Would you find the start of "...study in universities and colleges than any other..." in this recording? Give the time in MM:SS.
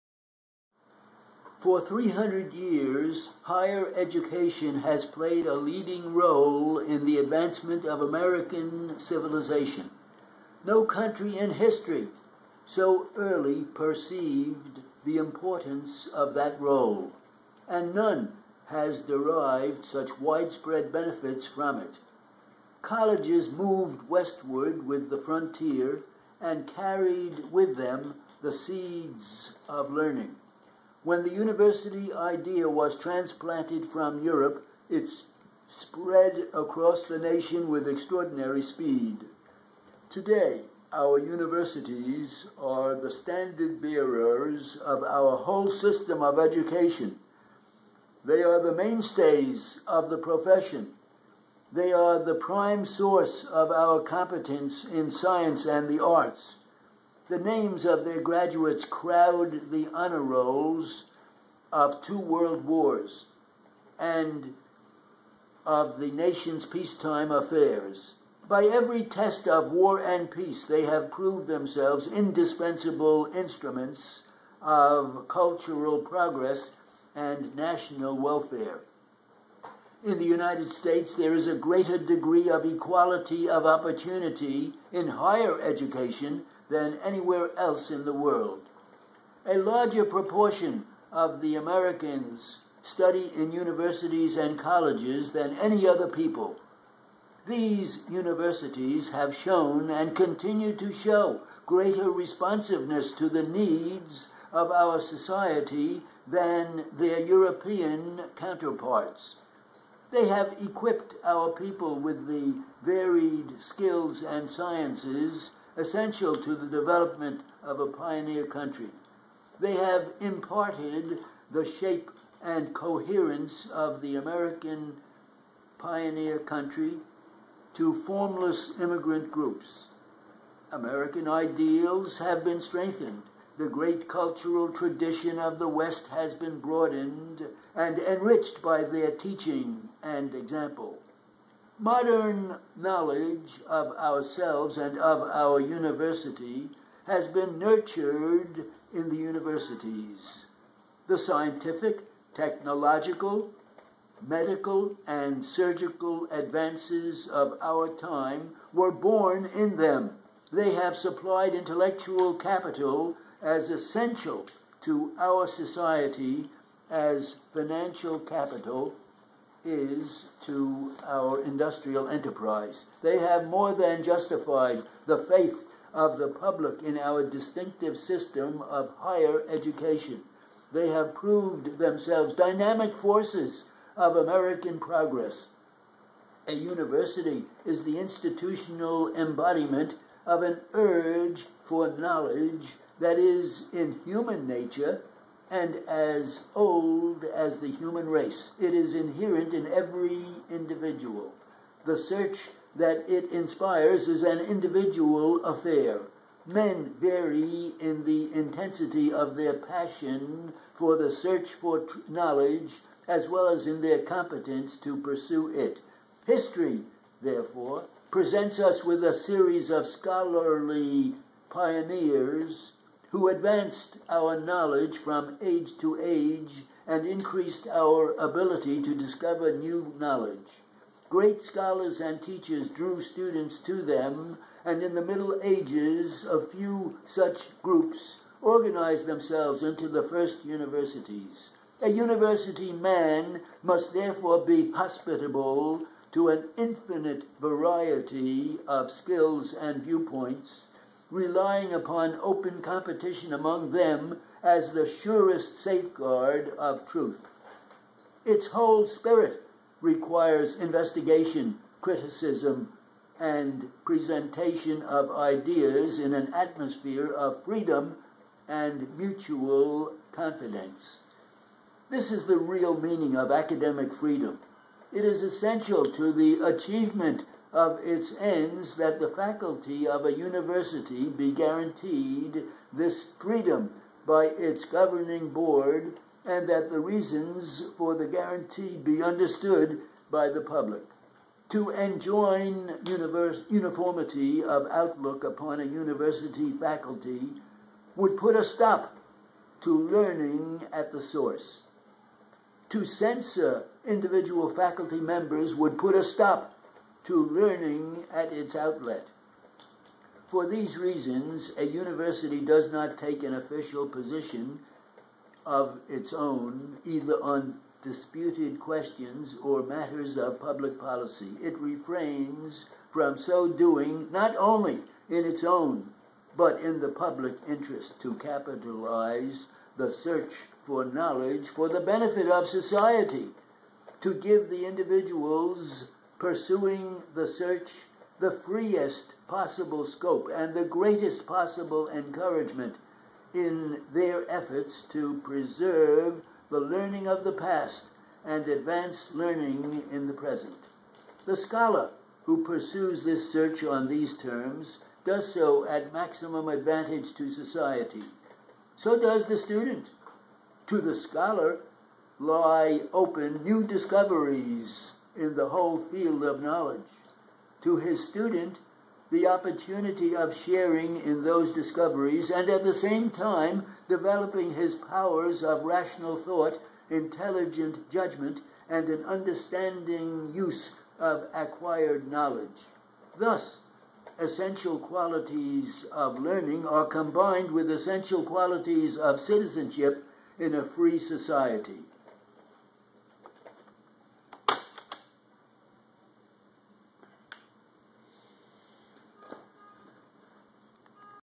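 01:32.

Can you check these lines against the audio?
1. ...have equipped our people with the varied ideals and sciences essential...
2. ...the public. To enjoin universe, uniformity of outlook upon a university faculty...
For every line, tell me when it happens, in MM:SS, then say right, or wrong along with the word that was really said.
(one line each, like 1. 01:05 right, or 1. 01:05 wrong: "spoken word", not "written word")
1. 01:50 wrong: "skills", not "ideals"
2. 04:50 right.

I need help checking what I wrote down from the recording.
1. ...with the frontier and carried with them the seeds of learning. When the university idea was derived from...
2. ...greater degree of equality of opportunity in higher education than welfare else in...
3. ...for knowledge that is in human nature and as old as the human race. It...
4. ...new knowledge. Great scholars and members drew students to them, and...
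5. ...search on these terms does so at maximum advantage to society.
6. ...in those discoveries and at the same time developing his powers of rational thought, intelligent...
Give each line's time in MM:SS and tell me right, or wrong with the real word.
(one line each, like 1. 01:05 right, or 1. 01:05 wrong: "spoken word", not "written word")
1. 00:24 wrong: "transplanted", not "derived"
2. 01:21 wrong: "anywhere", not "welfare"
3. 03:11 right
4. 03:49 wrong: "teachers", not "members"
5. 05:53 right
6. 06:11 right.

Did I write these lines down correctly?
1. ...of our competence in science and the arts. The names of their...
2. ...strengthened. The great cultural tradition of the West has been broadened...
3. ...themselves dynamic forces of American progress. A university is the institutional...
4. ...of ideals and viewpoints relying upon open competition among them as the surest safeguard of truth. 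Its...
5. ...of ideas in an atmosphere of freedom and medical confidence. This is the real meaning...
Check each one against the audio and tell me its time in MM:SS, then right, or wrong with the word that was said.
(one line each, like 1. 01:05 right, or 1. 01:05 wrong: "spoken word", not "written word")
1. 00:53 right
2. 02:12 right
3. 03:01 right
4. 04:08 wrong: "skills", not "ideals"
5. 04:24 wrong: "mutual", not "medical".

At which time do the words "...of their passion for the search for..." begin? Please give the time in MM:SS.
03:29.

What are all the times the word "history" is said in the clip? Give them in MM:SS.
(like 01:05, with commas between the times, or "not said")
00:11, 03:36.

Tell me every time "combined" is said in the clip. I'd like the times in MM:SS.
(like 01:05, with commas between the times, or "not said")
06:26.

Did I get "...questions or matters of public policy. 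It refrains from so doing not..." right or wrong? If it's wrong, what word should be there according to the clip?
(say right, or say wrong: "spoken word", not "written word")
right.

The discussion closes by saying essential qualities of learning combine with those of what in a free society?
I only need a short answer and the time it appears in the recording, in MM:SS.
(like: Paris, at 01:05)
citizenship, at 06:29.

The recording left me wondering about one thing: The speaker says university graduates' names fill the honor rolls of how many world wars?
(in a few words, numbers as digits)
2.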